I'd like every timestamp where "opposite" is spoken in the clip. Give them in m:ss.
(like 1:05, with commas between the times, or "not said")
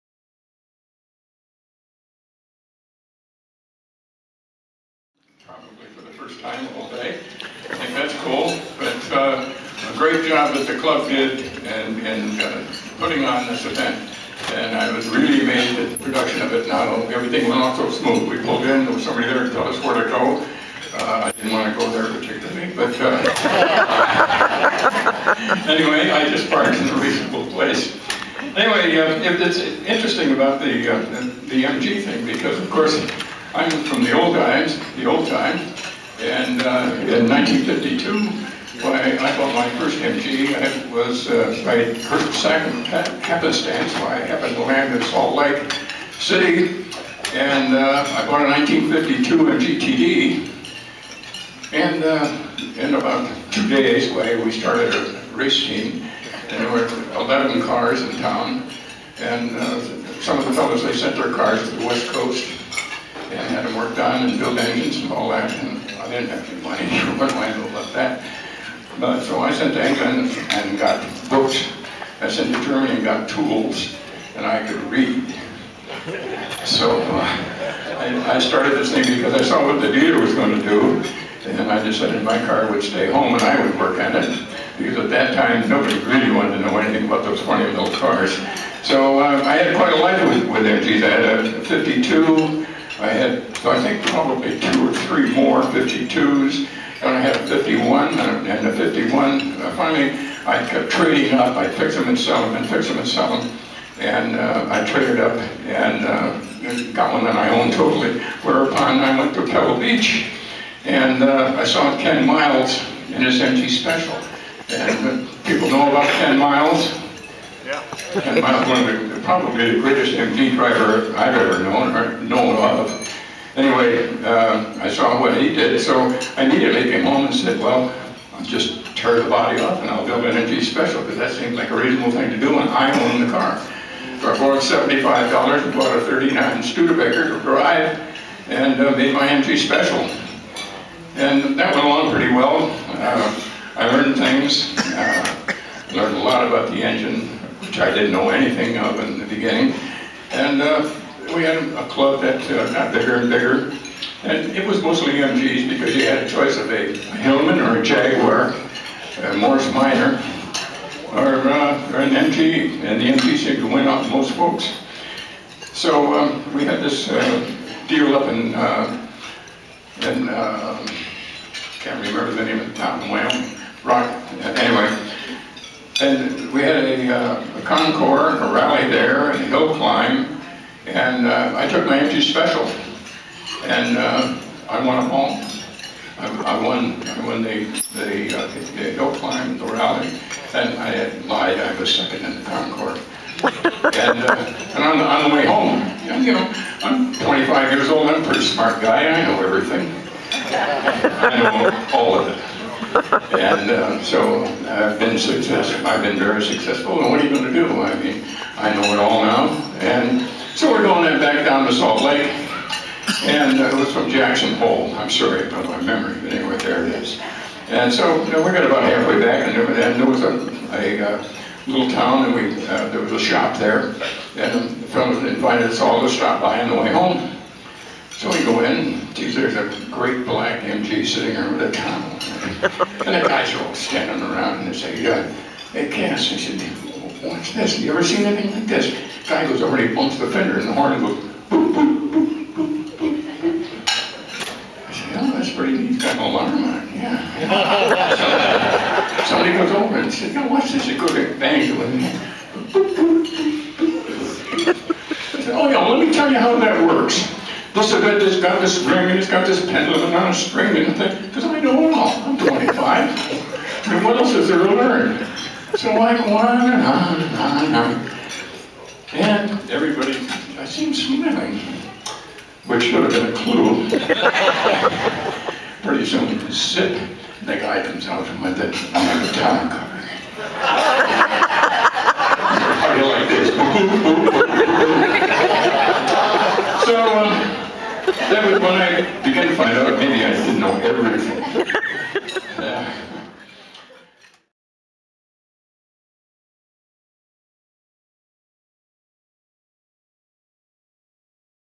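not said.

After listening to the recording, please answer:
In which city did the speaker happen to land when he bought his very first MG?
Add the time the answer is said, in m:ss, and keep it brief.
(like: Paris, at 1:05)
Salt Lake City, at 0:45.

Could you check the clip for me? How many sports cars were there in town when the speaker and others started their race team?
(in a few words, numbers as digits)
11.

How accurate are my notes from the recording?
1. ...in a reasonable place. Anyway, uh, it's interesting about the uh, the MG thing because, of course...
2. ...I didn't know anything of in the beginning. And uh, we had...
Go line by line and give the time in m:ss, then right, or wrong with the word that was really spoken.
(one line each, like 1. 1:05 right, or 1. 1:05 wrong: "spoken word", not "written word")
1. 0:26 right
2. 2:27 right.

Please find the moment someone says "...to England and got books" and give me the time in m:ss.
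1:09.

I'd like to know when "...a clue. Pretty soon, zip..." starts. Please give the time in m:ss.
4:33.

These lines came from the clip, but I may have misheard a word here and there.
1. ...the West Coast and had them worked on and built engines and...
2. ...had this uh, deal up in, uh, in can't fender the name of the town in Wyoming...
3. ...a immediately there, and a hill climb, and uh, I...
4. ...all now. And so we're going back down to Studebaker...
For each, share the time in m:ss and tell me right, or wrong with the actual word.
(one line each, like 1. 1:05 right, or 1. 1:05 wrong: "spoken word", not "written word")
1. 1:01 right
2. 2:46 wrong: "remember", not "fender"
3. 2:58 wrong: "rally", not "immediately"
4. 3:28 wrong: "Salt", not "Studebaker".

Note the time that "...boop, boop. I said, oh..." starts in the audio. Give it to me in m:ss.
4:02.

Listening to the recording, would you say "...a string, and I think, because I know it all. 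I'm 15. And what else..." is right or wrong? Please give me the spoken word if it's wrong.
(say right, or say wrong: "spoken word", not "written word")
wrong: "25", not "15".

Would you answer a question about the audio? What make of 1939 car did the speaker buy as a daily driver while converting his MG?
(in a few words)
Studebaker.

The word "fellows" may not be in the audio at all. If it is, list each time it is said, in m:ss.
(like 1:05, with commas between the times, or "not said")
1:00, 3:44.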